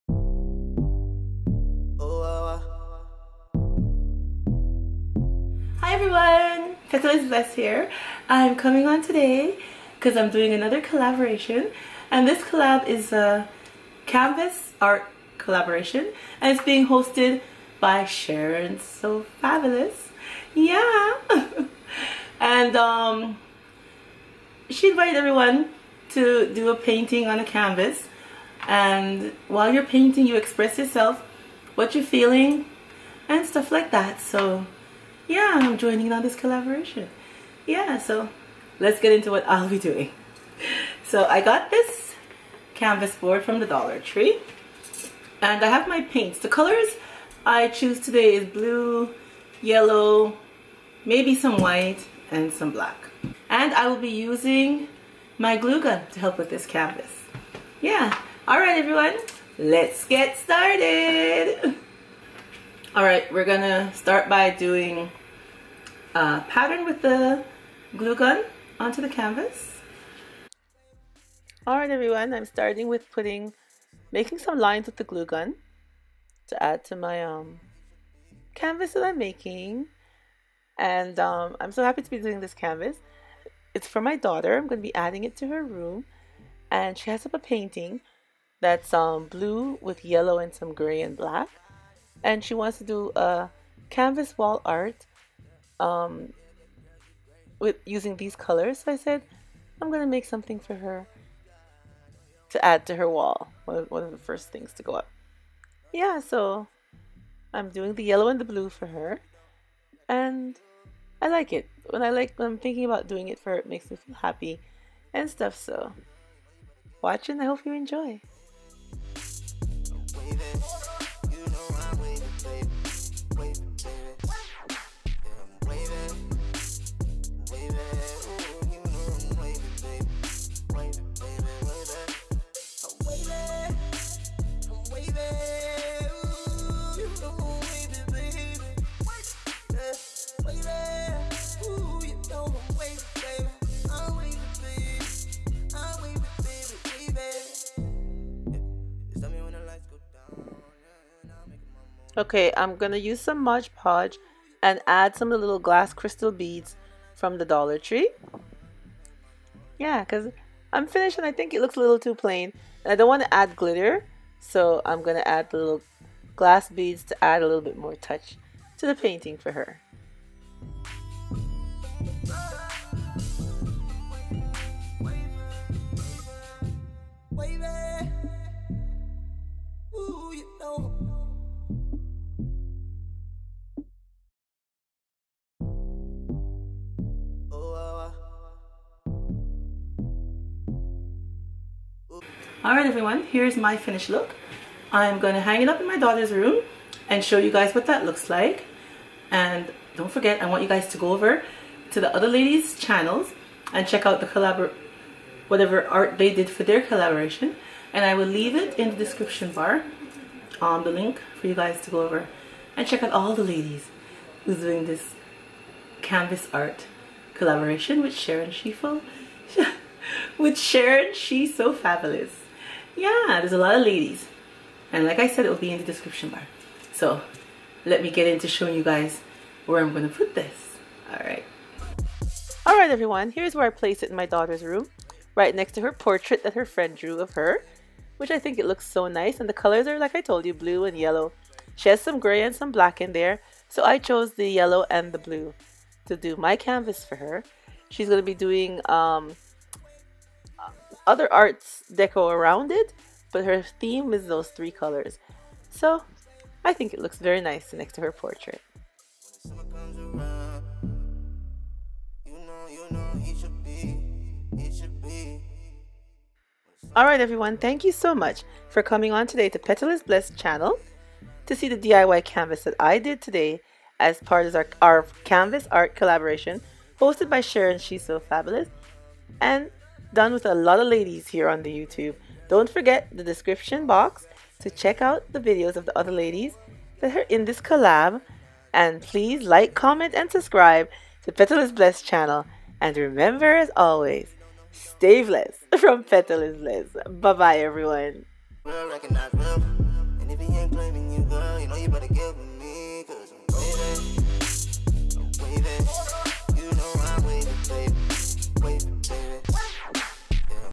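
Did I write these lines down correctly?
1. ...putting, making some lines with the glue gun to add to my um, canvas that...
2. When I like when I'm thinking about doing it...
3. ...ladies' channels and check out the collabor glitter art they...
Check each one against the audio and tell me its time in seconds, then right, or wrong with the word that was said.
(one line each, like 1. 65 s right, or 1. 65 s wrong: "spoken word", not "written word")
1. 73 s right
2. 111 s right
3. 202 s wrong: "whatever", not "glitter".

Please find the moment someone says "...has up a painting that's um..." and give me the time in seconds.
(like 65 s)
87 s.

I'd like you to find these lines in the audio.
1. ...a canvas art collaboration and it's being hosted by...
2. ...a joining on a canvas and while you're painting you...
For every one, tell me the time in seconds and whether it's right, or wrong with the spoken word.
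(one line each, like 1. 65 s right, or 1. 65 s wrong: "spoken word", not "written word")
1. 13 s right
2. 26 s wrong: "painting", not "joining".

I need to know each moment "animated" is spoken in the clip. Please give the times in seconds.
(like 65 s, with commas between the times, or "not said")
not said.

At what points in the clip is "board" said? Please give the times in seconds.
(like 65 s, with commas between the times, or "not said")
43 s.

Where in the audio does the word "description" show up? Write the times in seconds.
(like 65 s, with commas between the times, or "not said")
208 s, 225 s, 283 s.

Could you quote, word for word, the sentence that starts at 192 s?
Alright everyone, here's my finished look.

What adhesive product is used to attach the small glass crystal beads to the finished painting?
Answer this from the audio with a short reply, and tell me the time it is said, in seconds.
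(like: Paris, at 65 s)
Mod Podge, at 153 s.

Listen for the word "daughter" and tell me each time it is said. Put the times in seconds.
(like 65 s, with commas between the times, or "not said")
84 s, 195 s, 234 s.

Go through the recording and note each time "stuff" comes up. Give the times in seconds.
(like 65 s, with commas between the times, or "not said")
33 s, 115 s.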